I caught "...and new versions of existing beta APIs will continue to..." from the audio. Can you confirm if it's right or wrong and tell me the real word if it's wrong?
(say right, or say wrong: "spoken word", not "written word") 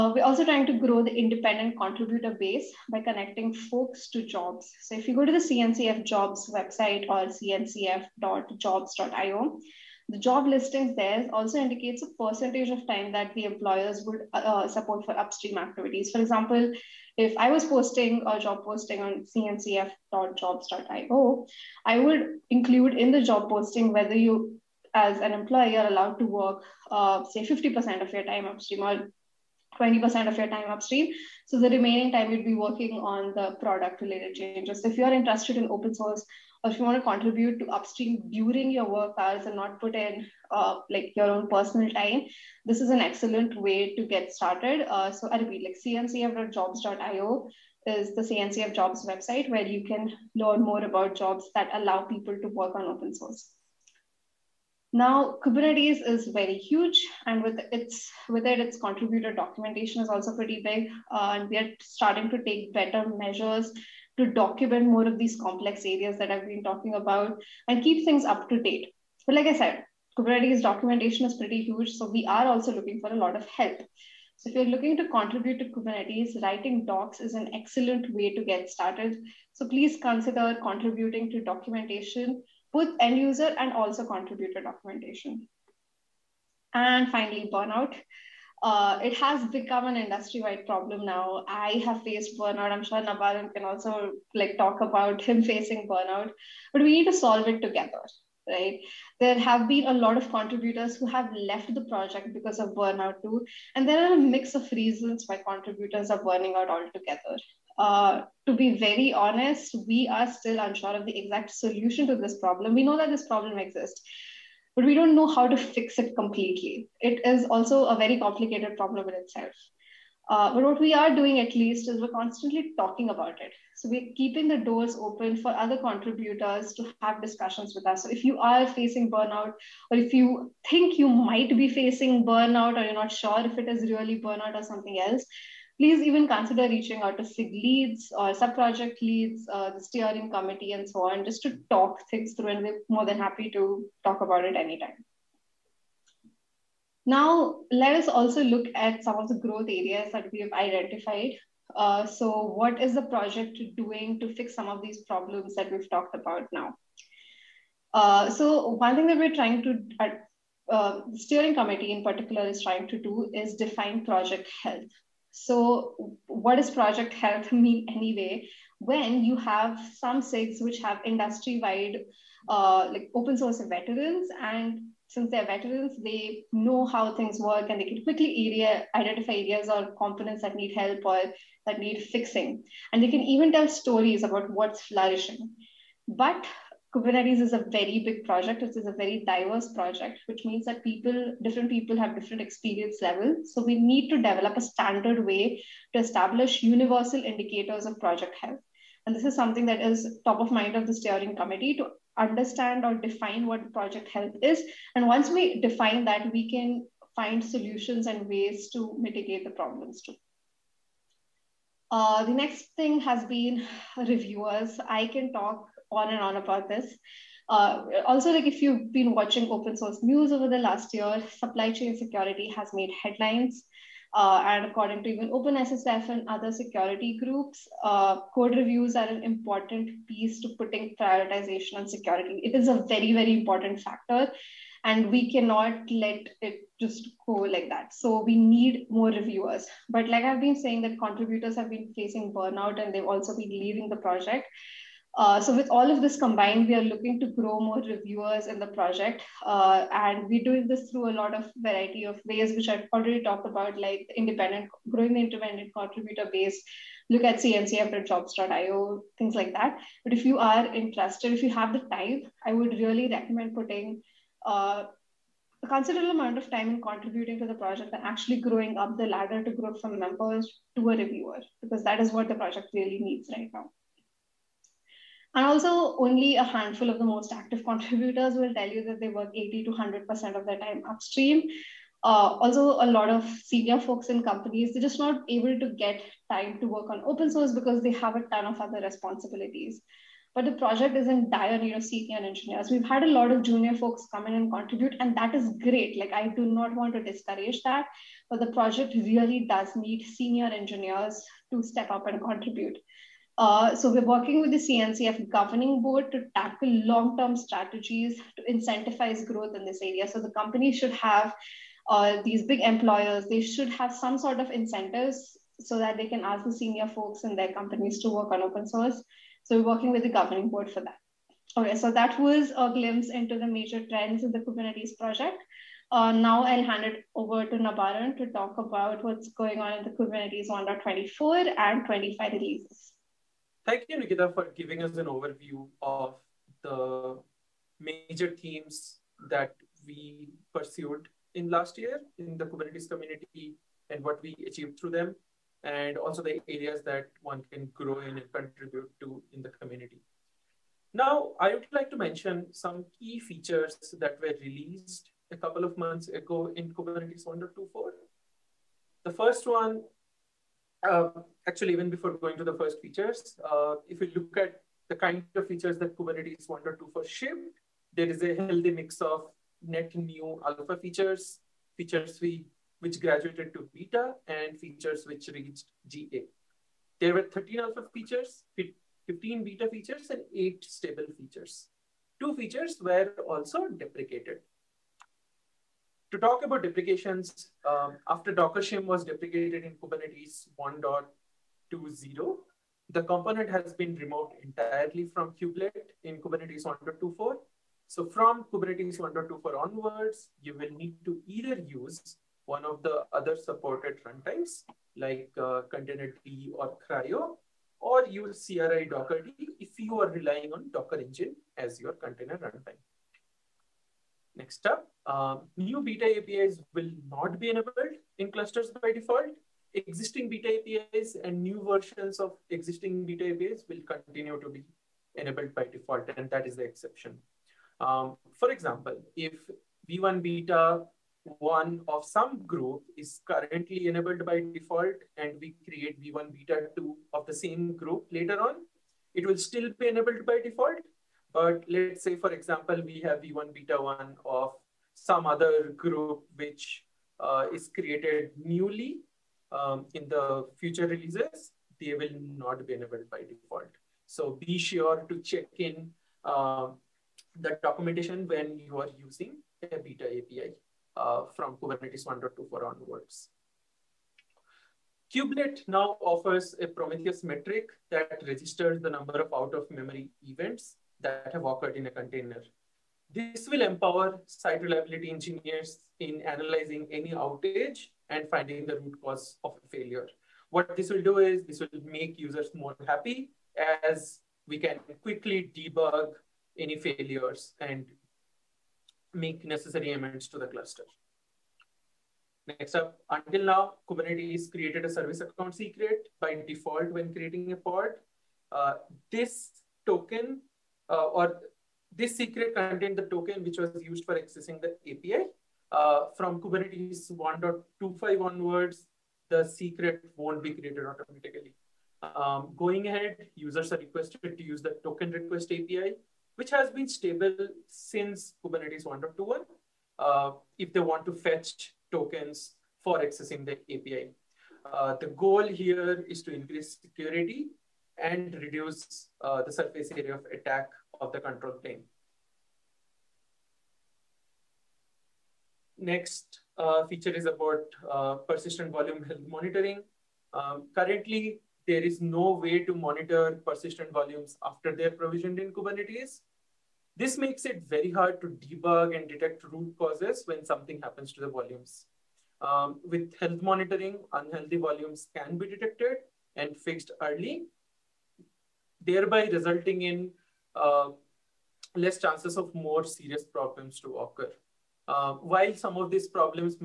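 right.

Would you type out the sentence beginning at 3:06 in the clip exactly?
But Kubernetes is a very big project.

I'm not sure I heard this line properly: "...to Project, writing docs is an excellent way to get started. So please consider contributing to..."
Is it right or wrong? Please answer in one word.
wrong.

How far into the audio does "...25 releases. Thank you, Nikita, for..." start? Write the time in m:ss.
5:31.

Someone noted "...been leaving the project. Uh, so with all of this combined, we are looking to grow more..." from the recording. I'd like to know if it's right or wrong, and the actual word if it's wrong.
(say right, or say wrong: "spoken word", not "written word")
right.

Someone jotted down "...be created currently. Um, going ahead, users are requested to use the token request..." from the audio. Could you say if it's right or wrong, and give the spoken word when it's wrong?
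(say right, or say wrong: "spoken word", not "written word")
wrong: "automatically", not "currently".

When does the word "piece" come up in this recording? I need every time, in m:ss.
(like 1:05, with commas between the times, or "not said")
3:50.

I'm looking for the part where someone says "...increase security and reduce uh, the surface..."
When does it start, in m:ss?
8:46.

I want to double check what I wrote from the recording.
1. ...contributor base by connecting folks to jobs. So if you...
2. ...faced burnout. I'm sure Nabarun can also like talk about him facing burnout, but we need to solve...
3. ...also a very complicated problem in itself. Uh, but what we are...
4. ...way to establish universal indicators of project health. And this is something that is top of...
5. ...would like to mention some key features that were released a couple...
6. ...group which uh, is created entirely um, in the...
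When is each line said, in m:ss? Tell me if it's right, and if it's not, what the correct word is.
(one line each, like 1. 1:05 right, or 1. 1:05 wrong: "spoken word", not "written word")
1. 0:01 right
2. 1:32 right
3. 1:57 right
4. 3:15 right
5. 5:51 right
6. 7:25 wrong: "newly", not "entirely".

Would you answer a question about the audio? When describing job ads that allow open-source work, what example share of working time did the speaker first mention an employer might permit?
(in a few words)
50%.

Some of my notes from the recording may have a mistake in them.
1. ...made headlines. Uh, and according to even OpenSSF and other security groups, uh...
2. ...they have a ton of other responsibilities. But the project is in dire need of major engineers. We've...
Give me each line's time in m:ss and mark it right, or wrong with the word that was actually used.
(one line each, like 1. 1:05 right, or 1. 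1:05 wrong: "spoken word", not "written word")
1. 3:42 right
2. 4:47 wrong: "senior", not "major".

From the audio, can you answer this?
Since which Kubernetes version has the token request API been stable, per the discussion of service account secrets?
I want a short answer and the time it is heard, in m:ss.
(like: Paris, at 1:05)
1.21, at 8:38.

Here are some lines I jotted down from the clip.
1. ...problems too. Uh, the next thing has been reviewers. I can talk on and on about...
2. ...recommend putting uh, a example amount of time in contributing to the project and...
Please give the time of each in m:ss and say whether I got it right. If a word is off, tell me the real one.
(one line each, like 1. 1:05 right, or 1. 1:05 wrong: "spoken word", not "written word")
1. 3:29 right
2. 4:23 wrong: "considerable", not "example".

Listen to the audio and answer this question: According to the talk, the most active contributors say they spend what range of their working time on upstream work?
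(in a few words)
80 to 100%.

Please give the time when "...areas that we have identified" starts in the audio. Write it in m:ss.
2:29.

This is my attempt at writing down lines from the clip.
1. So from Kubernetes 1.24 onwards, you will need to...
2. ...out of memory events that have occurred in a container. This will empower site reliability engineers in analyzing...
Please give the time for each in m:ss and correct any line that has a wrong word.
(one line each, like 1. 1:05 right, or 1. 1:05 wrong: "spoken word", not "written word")
1. 6:37 right
2. 7:49 right.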